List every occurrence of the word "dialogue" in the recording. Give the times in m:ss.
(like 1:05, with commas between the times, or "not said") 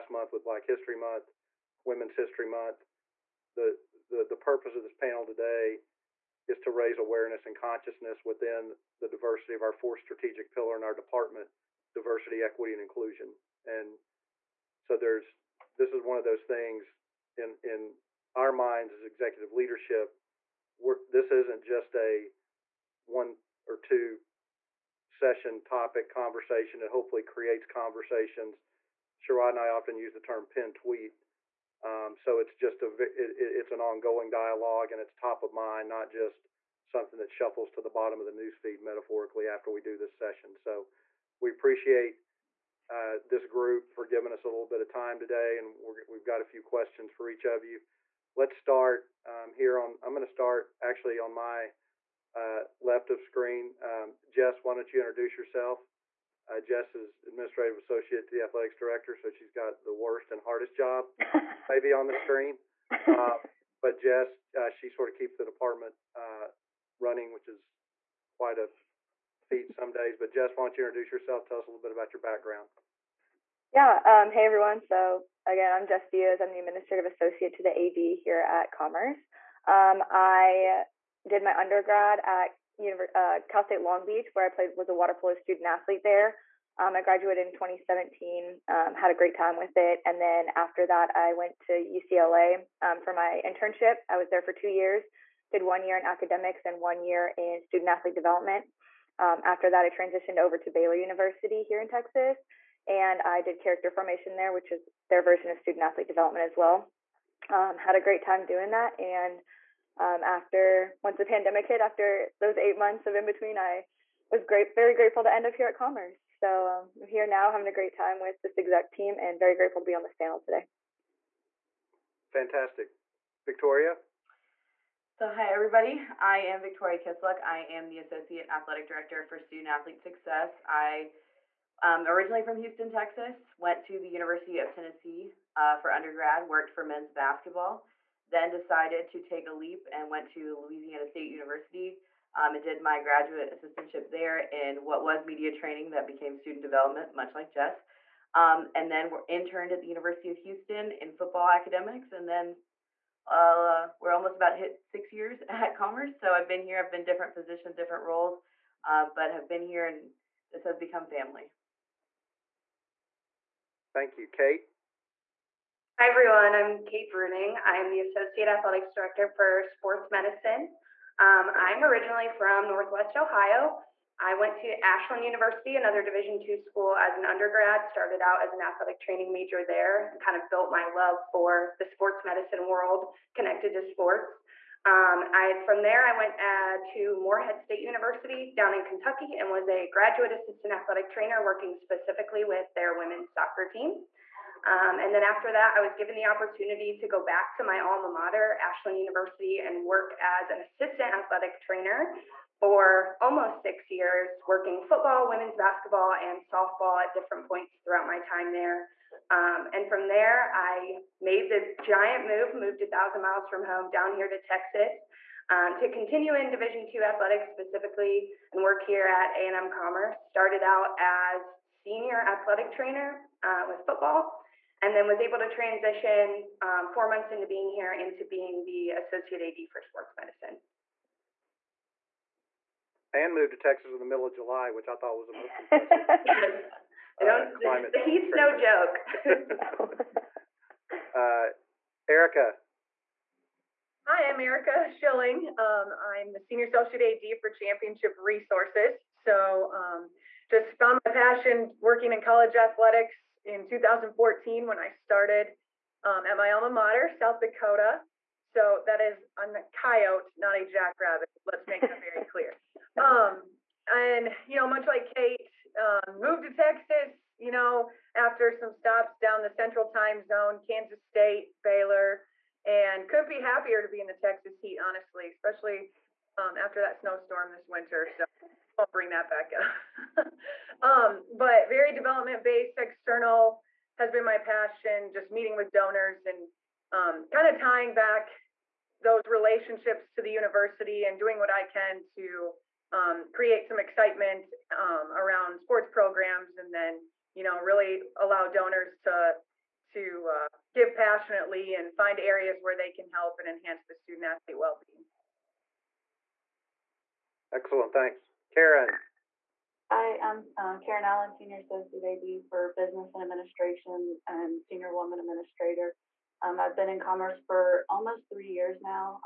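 0:34.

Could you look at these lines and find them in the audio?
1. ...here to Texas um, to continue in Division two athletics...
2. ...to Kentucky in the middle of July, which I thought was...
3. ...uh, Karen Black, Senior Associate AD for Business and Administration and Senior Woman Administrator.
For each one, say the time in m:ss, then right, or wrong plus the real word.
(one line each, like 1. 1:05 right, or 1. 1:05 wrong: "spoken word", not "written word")
1. 3:34 right
2. 3:53 wrong: "Texas", not "Kentucky"
3. 5:10 wrong: "Allen", not "Black".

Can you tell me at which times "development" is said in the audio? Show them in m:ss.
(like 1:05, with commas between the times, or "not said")
1:38, 1:46, 2:26, 4:41.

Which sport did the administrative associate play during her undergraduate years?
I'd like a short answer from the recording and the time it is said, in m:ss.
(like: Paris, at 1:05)
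Water polo, at 1:24.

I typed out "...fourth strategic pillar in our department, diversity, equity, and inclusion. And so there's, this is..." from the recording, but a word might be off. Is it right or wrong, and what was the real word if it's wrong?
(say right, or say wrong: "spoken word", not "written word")
right.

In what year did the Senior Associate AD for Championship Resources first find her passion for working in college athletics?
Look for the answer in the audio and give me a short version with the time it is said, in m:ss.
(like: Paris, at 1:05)
2014, at 4:13.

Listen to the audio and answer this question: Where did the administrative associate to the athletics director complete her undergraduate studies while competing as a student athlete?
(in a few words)
Cal State Long Beach.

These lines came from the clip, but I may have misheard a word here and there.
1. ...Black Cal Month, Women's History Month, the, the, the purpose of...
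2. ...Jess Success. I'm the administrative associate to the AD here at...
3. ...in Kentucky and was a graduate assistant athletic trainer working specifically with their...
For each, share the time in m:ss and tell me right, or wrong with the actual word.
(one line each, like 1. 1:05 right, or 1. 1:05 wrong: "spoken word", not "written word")
1. 0:00 wrong: "History", not "Cal"
2. 1:15 wrong: "Diaz", not "Success"
3. 3:08 right.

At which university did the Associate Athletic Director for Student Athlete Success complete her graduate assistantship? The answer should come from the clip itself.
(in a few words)
Louisiana State University.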